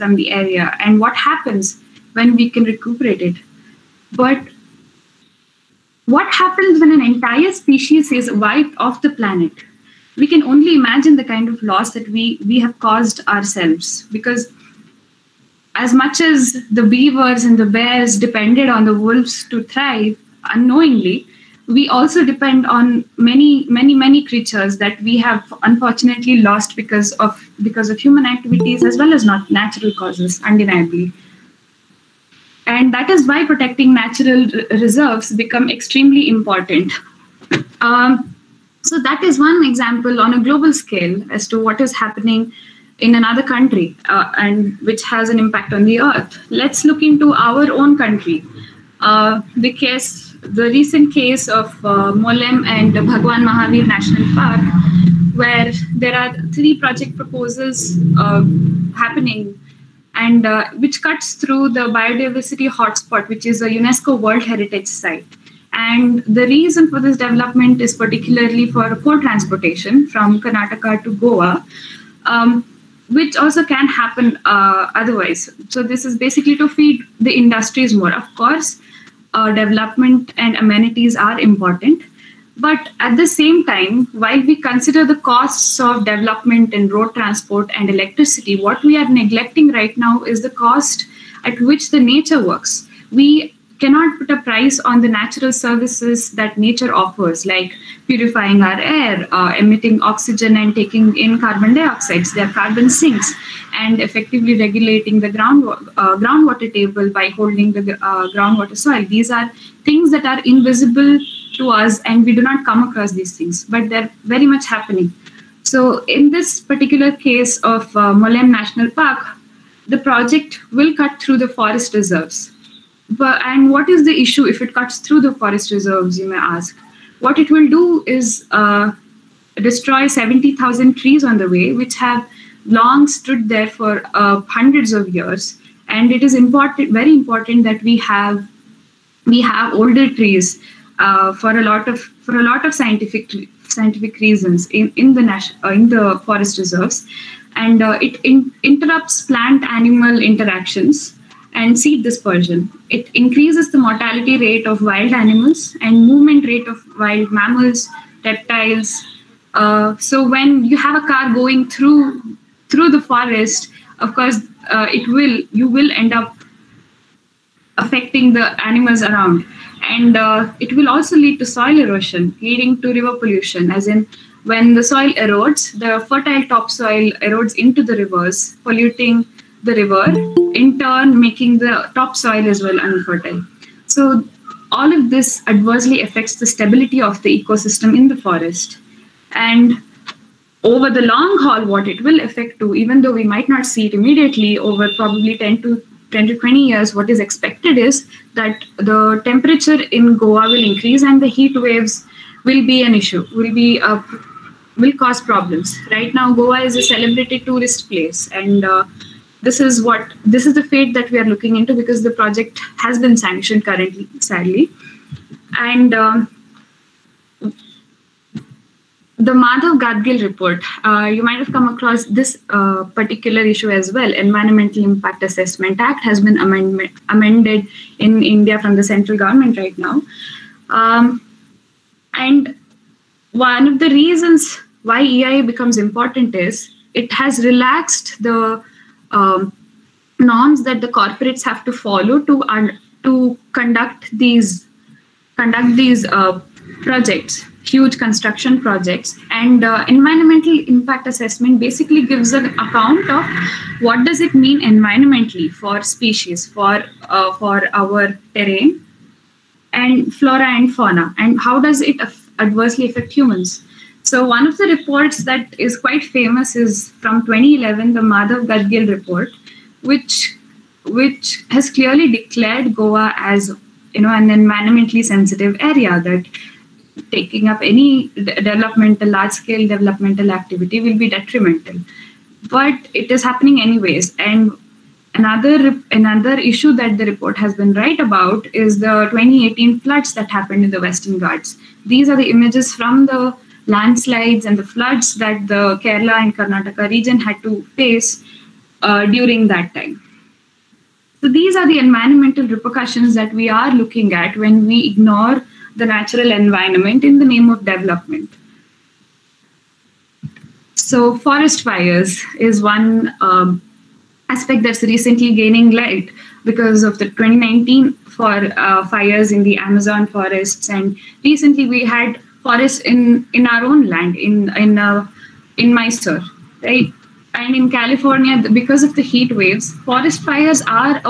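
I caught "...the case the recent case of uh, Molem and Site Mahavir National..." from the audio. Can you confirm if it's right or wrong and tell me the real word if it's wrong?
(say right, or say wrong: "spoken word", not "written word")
wrong: "Bhagwan", not "Site".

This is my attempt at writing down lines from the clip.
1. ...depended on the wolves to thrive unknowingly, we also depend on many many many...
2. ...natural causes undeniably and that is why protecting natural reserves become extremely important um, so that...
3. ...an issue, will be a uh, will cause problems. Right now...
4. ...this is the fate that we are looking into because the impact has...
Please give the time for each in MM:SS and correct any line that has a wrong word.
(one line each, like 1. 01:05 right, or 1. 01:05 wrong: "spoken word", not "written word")
1. 00:18 right
2. 00:29 right
3. 03:22 right
4. 03:30 wrong: "project", not "impact".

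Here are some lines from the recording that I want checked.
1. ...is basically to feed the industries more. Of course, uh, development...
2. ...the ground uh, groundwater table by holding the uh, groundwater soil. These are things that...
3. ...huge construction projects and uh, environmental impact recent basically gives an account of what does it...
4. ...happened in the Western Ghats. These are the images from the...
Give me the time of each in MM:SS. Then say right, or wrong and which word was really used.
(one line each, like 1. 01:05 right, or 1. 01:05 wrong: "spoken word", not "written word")
1. 01:16 right
2. 01:45 right
3. 04:07 wrong: "assessment", not "recent"
4. 04:50 right.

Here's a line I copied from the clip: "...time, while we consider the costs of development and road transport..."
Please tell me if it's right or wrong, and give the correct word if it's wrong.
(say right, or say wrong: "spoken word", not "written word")
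right.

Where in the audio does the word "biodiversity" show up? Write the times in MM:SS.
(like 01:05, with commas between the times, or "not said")
01:01.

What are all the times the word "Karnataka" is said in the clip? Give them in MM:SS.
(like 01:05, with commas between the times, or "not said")
01:10, 04:56.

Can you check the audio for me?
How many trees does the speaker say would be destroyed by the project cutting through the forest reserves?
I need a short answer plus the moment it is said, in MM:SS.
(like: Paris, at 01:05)
70,000, at 02:10.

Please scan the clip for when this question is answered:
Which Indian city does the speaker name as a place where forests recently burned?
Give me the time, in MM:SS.
05:25.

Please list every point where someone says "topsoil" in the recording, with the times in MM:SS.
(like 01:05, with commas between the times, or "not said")
02:56, 03:01.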